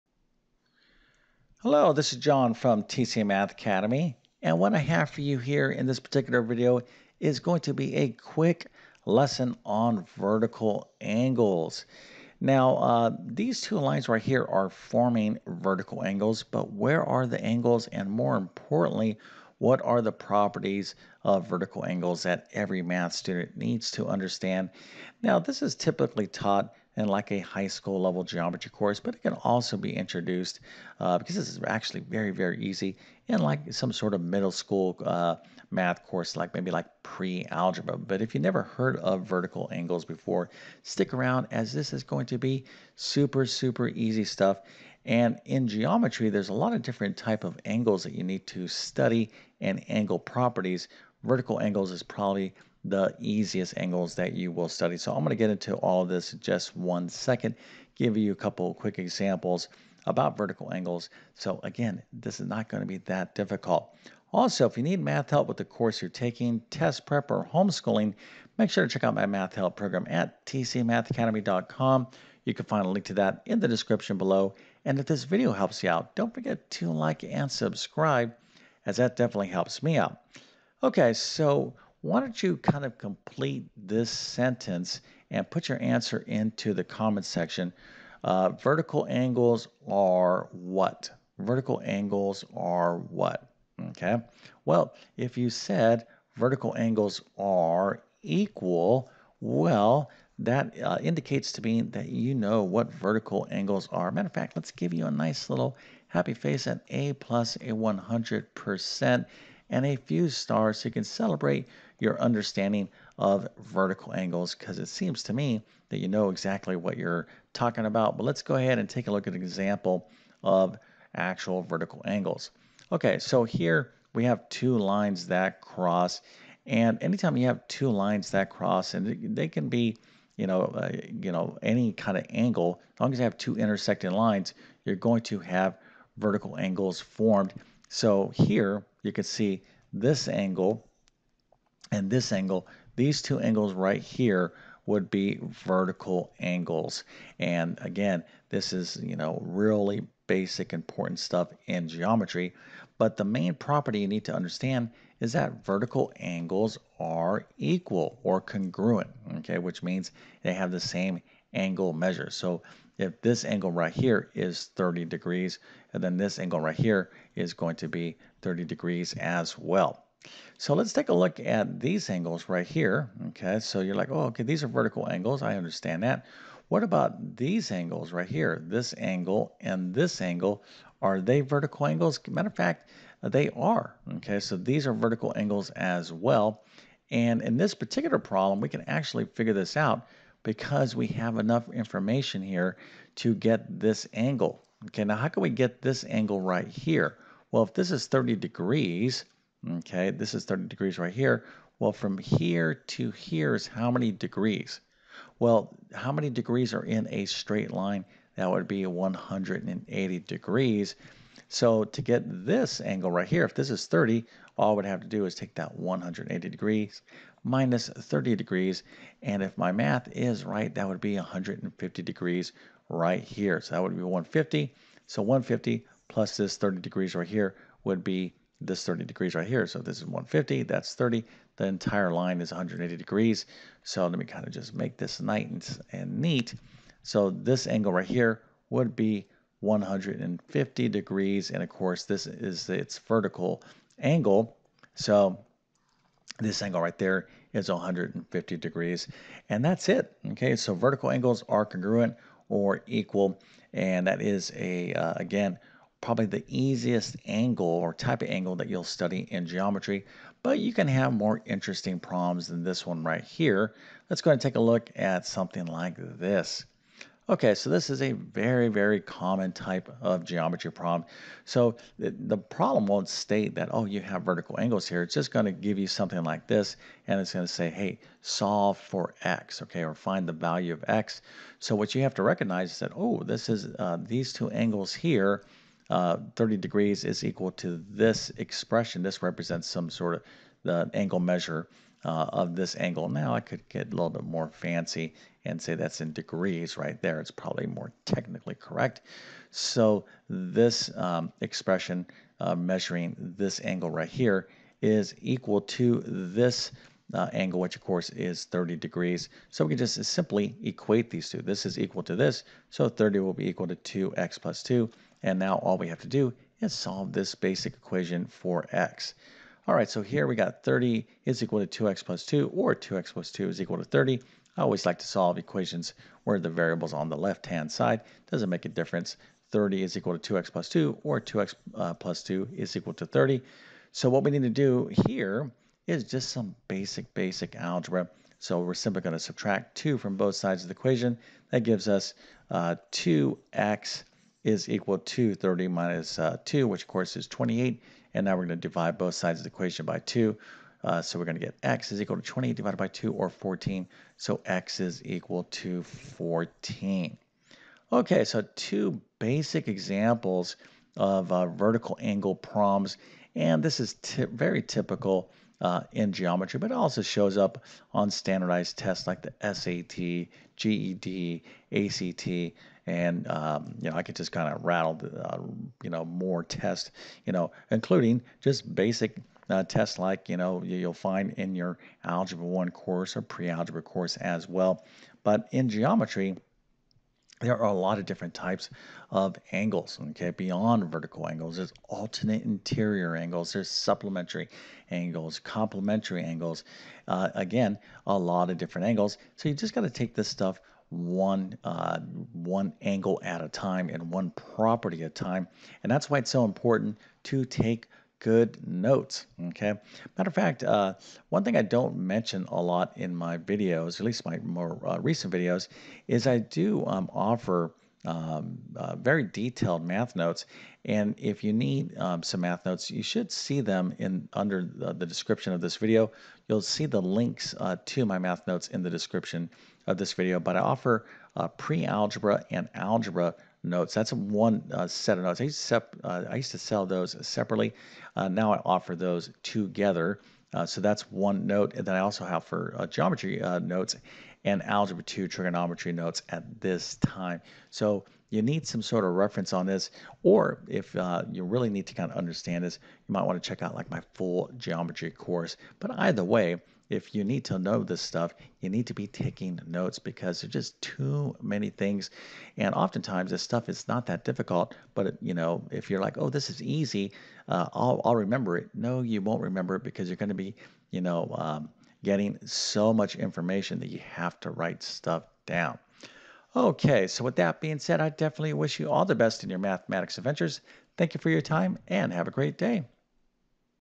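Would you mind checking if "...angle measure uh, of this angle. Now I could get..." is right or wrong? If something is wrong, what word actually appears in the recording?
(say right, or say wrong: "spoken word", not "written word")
right.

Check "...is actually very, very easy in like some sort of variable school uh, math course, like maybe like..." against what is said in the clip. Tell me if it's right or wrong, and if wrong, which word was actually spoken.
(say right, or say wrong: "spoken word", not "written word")
wrong: "middle", not "variable".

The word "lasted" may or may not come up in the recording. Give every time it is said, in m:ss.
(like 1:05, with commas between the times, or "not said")
not said.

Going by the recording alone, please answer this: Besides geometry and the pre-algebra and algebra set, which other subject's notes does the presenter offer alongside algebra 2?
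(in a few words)
trigonometry.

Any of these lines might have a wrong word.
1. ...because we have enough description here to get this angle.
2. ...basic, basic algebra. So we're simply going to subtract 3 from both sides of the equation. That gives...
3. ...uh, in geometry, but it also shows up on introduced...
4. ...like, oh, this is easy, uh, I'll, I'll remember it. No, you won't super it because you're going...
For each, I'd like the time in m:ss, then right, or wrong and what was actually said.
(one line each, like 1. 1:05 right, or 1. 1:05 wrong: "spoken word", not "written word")
1. 3:10 wrong: "information", not "description"
2. 5:36 wrong: "2", not "3"
3. 6:05 wrong: "standardized", not "introduced"
4. 7:46 wrong: "remember", not "super".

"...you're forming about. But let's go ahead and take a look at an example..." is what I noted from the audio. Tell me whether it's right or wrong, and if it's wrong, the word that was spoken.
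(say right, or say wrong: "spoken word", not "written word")
wrong: "talking", not "forming".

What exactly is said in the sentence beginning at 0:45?
And in geometry, there's a lot of different type of angles that you need to study and angle properties.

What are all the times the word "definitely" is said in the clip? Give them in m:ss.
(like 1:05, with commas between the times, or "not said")
1:19, 7:58.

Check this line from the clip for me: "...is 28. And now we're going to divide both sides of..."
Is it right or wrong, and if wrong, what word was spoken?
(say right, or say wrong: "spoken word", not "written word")
right.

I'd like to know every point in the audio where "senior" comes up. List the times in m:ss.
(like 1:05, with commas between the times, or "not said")
not said.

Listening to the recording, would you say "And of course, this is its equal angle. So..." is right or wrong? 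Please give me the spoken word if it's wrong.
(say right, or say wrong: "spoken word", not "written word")
wrong: "vertical", not "equal".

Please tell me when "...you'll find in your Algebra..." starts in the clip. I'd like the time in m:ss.
6:20.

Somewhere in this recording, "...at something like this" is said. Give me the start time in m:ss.
4:24.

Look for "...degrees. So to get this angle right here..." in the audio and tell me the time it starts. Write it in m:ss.
3:30.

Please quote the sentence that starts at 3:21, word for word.
Well, from here to here is how many degrees?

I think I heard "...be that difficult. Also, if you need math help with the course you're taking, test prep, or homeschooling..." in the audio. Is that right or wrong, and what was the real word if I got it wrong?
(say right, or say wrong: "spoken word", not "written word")
right.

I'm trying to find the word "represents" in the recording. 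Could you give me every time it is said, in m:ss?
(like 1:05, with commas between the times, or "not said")
4:49.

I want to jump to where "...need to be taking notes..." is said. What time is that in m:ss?
7:38.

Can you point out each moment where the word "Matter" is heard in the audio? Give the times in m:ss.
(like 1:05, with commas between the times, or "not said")
1:44, 3:02, 6:50.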